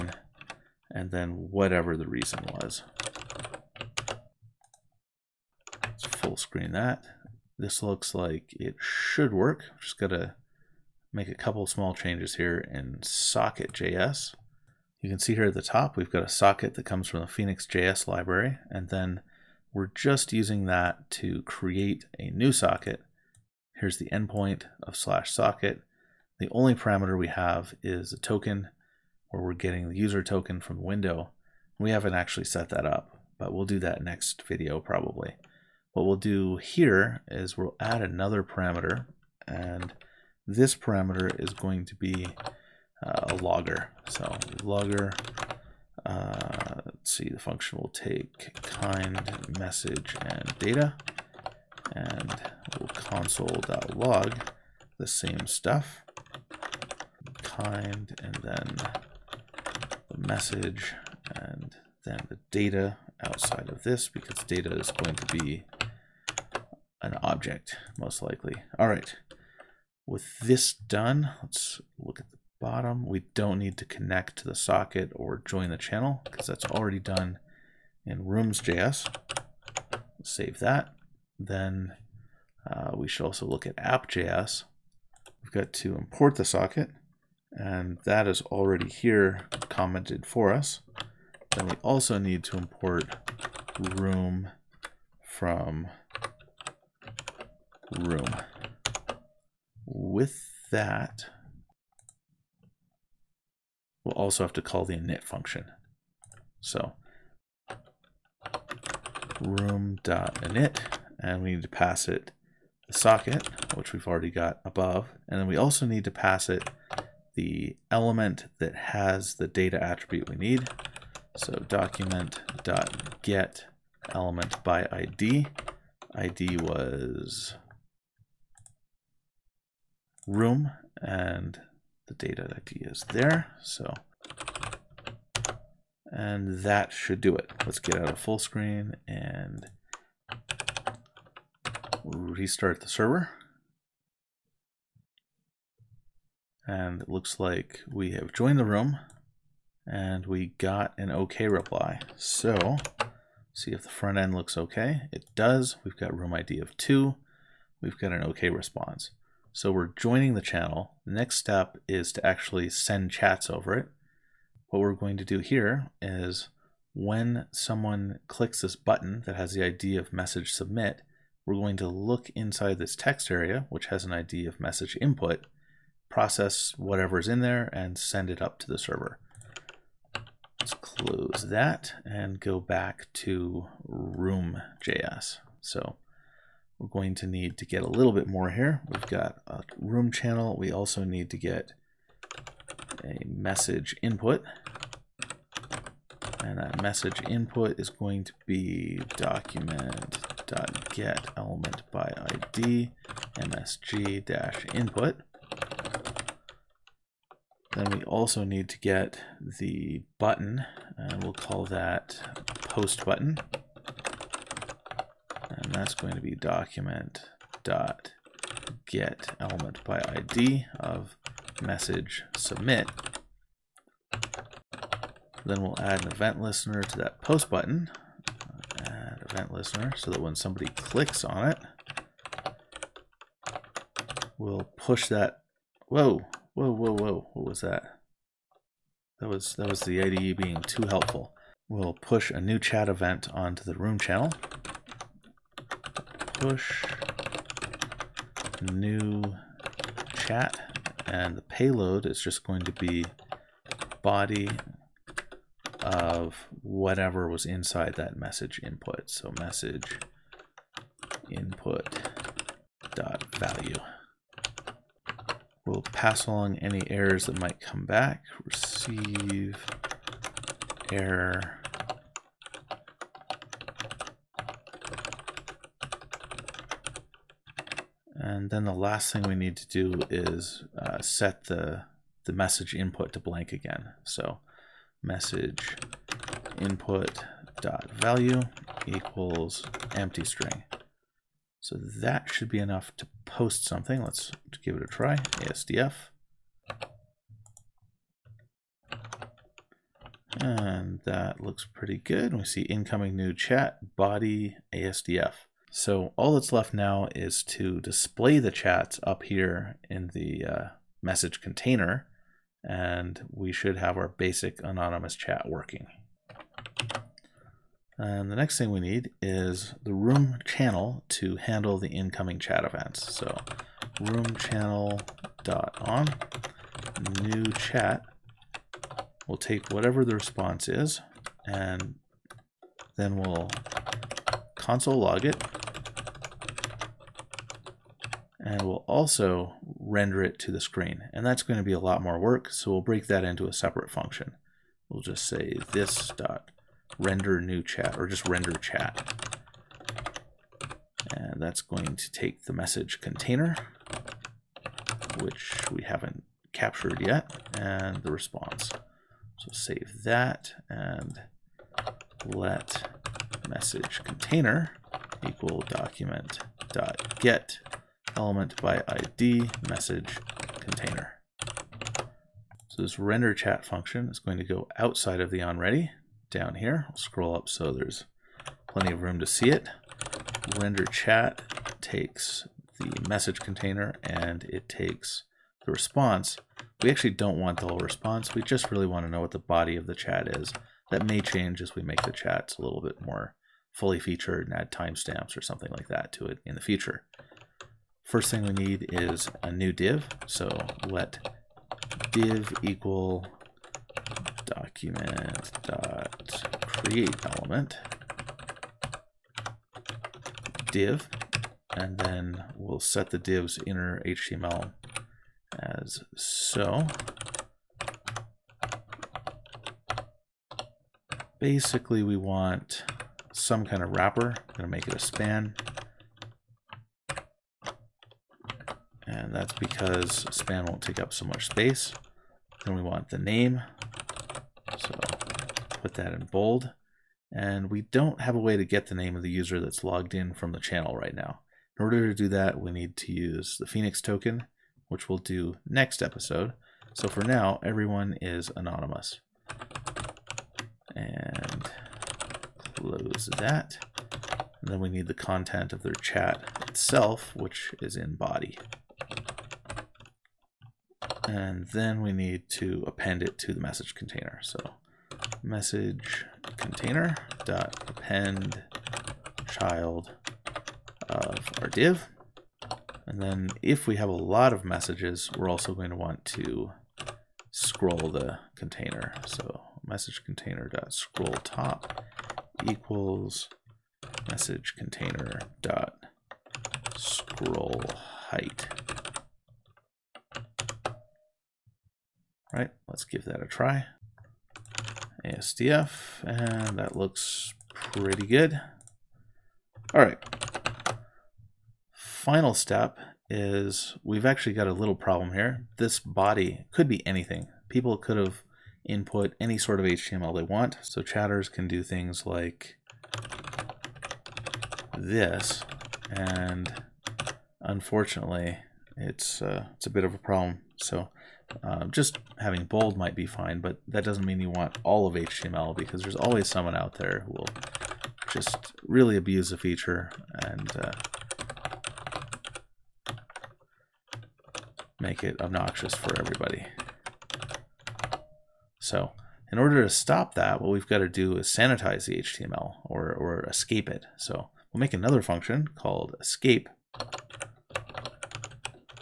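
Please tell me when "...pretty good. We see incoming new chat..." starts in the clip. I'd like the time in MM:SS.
05:01.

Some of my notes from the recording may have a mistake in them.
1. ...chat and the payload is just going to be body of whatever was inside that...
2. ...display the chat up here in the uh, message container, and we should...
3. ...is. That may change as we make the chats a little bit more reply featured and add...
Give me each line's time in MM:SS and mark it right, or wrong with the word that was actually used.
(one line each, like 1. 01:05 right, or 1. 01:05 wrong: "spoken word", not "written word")
1. 04:10 right
2. 05:07 right
3. 06:30 wrong: "fully", not "reply".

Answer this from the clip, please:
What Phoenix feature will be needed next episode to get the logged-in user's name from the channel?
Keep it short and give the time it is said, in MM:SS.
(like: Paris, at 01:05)
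Phoenix token, at 07:23.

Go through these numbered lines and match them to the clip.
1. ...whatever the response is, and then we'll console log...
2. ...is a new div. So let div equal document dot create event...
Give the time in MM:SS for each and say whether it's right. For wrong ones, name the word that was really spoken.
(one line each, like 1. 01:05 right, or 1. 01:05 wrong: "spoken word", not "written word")
1. 05:29 right
2. 06:38 wrong: "element", not "event".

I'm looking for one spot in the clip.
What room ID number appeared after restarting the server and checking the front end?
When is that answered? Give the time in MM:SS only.
02:36.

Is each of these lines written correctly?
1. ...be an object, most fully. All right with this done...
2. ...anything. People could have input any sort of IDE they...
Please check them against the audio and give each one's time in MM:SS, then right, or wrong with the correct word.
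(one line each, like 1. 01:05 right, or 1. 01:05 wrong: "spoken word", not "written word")
1. 01:05 wrong: "likely", not "fully"
2. 08:27 wrong: "HTML", not "IDE".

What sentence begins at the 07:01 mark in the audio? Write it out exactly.
Basically, we want some kind of wrapper.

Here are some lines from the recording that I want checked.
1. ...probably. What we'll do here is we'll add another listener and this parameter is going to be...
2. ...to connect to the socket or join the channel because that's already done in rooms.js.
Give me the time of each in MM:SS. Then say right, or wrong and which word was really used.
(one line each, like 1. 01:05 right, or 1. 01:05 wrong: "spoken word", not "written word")
1. 00:34 wrong: "parameter", not "listener"
2. 01:13 right.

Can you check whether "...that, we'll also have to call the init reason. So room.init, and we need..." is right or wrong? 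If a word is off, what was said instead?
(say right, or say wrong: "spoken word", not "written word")
wrong: "function", not "reason".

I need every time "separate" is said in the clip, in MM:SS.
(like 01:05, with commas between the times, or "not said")
05:43.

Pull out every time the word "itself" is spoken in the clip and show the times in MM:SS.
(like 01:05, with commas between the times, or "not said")
07:36.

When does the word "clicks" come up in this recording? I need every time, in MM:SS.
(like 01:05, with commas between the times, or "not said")
02:48, 03:50.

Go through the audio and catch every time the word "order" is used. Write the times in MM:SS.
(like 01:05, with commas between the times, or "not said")
07:21, 08:59.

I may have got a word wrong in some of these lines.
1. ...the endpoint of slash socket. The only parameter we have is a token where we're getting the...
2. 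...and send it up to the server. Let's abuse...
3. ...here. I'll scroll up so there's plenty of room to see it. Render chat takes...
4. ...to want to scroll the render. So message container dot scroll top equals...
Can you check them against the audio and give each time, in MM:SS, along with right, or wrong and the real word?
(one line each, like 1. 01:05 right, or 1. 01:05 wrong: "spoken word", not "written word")
1. 00:23 right
2. 02:57 wrong: "close", not "abuse"
3. 06:16 right
4. 07:55 wrong: "container", not "render".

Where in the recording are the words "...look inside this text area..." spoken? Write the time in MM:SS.
02:51.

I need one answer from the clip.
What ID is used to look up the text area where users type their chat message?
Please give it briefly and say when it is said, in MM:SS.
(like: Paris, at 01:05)
msg-input, at 03:23.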